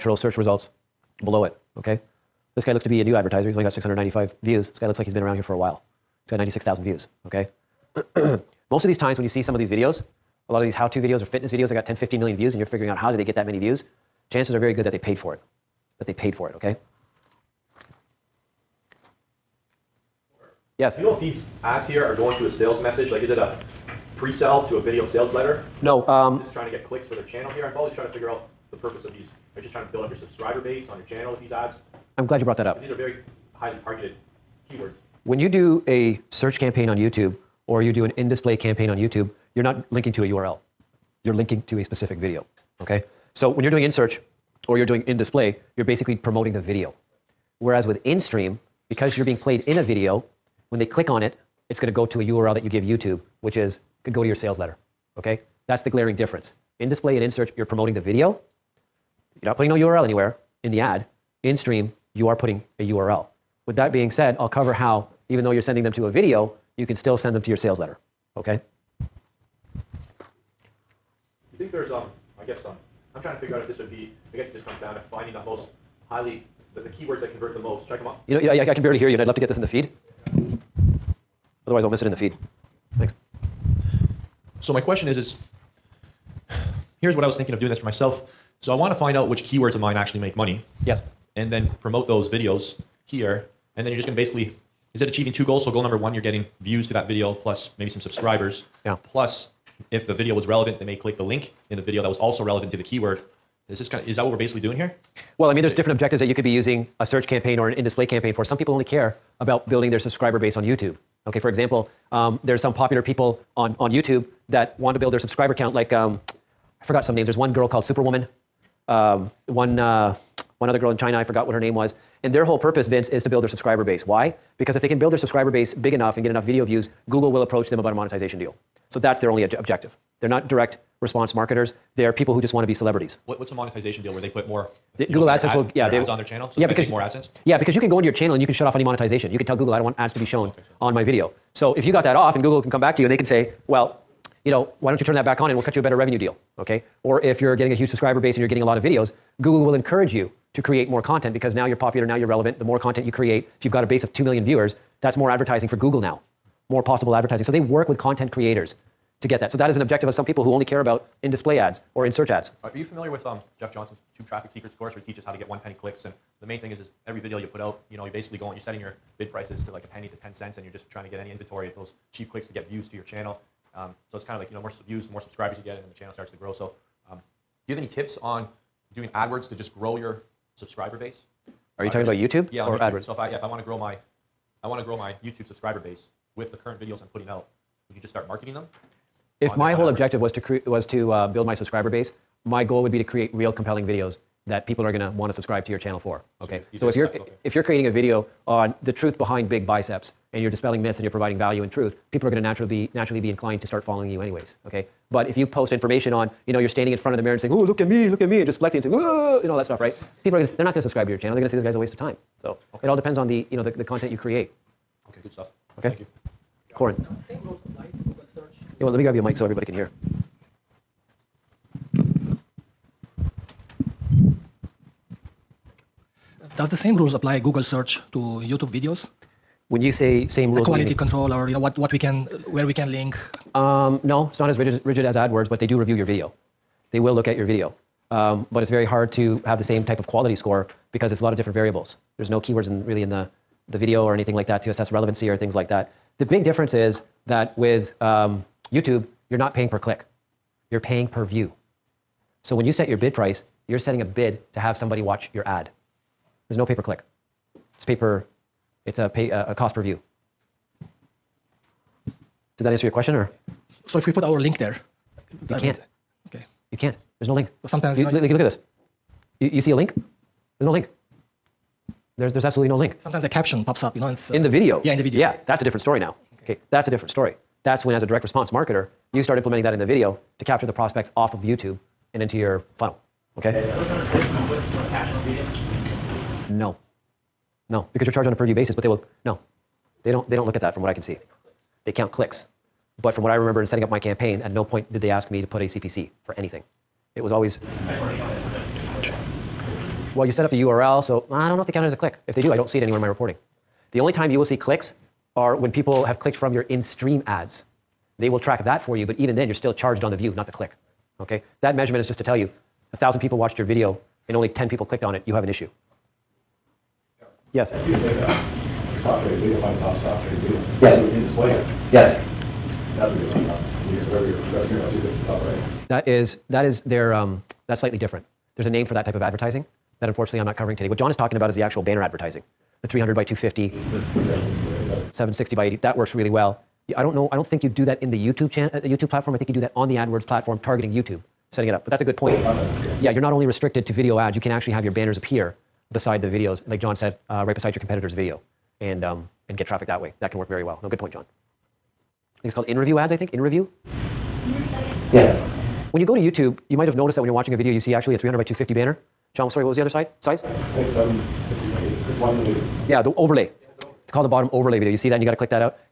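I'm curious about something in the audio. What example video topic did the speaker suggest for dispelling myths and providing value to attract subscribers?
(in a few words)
The truth behind big biceps.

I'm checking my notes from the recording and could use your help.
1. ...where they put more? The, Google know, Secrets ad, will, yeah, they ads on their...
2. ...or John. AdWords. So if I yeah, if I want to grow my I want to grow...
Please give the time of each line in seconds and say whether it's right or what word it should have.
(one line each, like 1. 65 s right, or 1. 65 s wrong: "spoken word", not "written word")
1. 134 s wrong: "AdSense", not "Secrets"
2. 182 s wrong: "YouTube", not "John".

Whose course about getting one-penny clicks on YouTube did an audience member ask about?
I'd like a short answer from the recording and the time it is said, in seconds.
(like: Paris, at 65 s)
Jeff Johnson, at 163 s.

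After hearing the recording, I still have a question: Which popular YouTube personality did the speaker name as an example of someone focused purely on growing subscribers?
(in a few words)
Superwoman.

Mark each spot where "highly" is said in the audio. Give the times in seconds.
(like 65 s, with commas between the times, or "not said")
33 s, 76 s.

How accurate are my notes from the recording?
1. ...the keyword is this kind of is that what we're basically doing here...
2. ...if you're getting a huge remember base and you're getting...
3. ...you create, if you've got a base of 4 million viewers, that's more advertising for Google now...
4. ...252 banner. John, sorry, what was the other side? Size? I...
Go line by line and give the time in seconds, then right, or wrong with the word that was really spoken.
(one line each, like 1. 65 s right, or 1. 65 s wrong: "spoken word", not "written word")
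1. 102 s right
2. 147 s wrong: "subscriber", not "remember"
3. 153 s wrong: "2", not "4"
4. 358 s wrong: "250", not "252".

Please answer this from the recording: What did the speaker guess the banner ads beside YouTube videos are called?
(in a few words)
In review ads.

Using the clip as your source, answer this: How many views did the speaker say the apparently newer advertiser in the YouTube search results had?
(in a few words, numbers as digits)
695.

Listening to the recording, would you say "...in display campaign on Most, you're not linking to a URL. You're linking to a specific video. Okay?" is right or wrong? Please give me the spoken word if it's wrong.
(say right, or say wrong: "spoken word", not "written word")
wrong: "YouTube", not "Most".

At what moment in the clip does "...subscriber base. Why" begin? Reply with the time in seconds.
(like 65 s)
123 s.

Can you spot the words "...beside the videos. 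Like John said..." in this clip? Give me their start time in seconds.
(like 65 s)
345 s.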